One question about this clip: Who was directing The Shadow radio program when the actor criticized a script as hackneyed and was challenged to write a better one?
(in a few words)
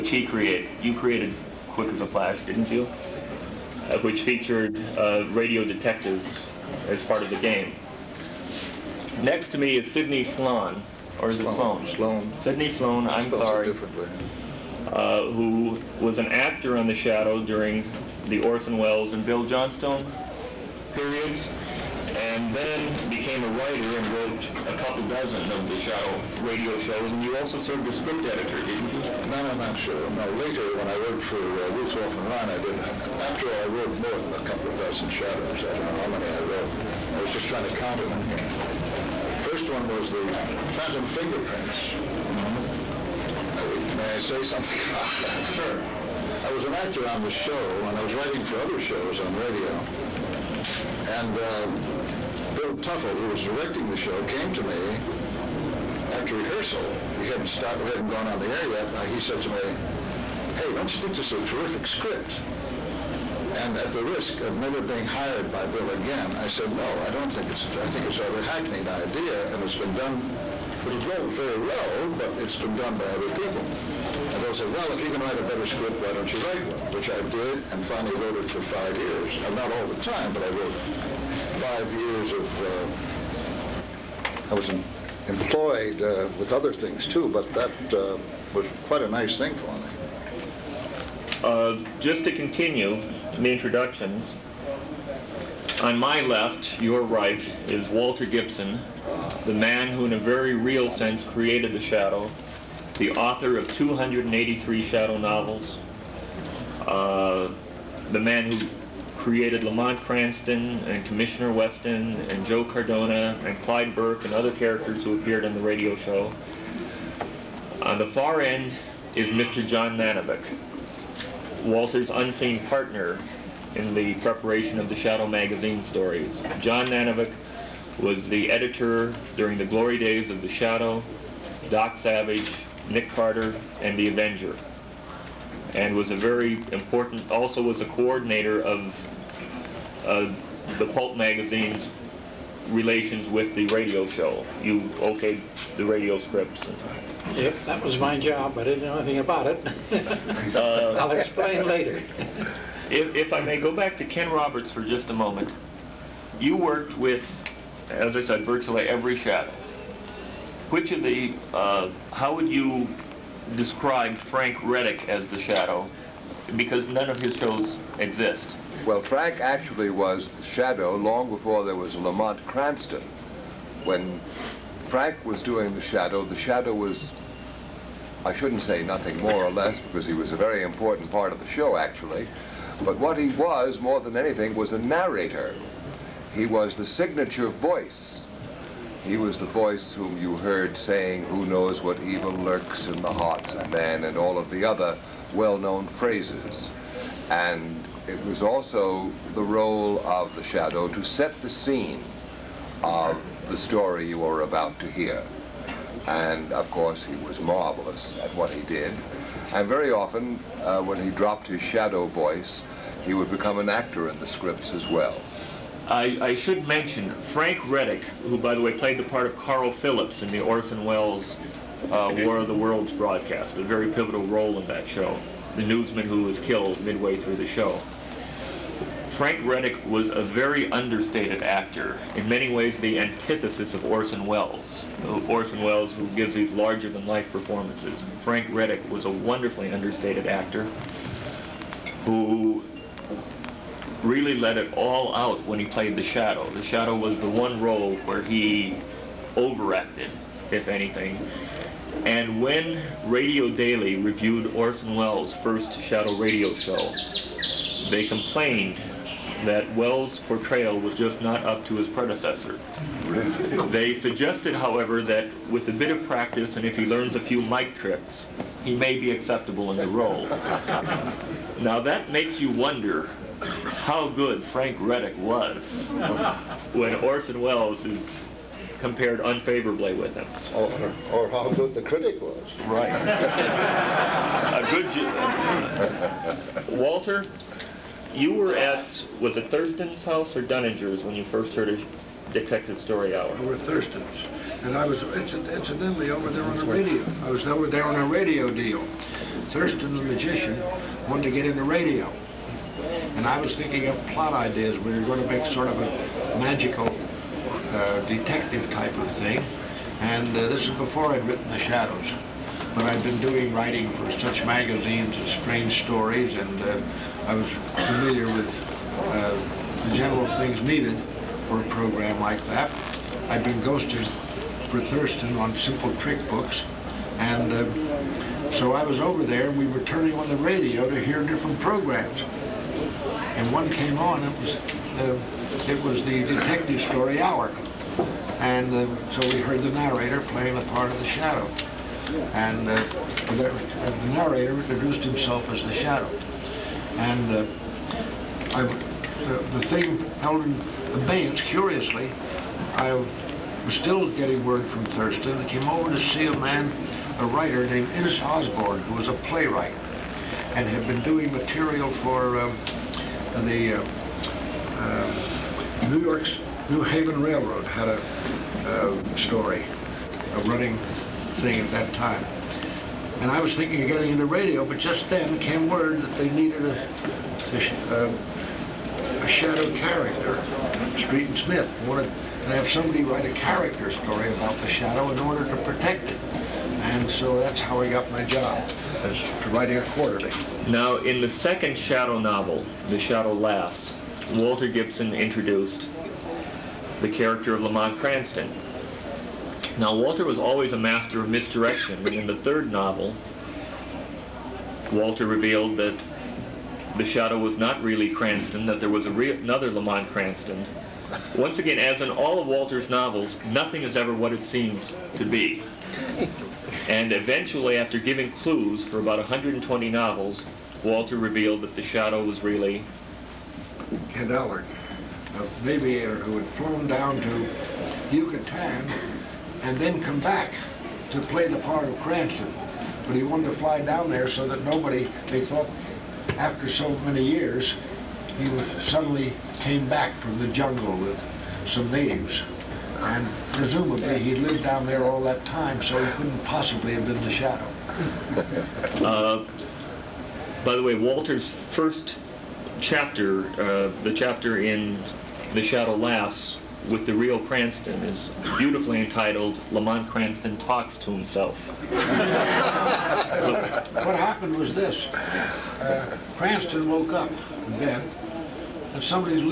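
Bill Tuttle.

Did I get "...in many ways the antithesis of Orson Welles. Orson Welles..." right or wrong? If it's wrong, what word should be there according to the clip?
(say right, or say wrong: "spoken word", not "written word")
right.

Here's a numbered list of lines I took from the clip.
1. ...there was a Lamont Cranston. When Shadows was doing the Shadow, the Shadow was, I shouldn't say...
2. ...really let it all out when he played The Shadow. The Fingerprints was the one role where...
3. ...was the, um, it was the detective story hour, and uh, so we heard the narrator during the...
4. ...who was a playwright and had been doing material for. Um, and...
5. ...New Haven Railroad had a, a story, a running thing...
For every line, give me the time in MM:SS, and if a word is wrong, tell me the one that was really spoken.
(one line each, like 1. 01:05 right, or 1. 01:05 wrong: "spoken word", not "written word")
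1. 02:51 wrong: "Frank", not "Shadows"
2. 04:04 wrong: "Shadow", not "Fingerprints"
3. 05:34 wrong: "playing", not "during"
4. 05:58 right
5. 06:06 right.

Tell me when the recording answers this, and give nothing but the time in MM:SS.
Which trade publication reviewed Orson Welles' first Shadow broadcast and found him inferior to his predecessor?
04:13.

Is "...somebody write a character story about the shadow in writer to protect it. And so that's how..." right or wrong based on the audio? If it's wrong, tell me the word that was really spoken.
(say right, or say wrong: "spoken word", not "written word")
wrong: "order", not "writer".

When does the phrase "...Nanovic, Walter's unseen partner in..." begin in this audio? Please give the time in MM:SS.
01:59.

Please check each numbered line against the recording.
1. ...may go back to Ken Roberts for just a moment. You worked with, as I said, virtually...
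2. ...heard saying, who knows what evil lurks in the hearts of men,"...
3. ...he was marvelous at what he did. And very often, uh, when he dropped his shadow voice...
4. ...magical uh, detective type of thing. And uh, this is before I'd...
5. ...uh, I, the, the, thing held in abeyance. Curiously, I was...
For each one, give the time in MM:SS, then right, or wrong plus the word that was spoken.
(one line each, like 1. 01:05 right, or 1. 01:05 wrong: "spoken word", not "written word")
1. 02:33 right
2. 03:10 right
3. 03:27 right
4. 05:06 right
5. 05:47 right.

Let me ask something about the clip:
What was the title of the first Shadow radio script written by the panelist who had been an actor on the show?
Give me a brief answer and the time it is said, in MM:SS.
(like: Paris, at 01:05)
The Phantom Fingerprints, at 00:40.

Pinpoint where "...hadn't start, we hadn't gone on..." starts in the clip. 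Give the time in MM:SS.
00:57.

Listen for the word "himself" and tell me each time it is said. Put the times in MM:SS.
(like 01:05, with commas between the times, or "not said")
05:45, 07:41.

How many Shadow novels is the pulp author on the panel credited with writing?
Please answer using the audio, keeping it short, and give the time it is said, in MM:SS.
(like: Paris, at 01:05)
283, at 01:43.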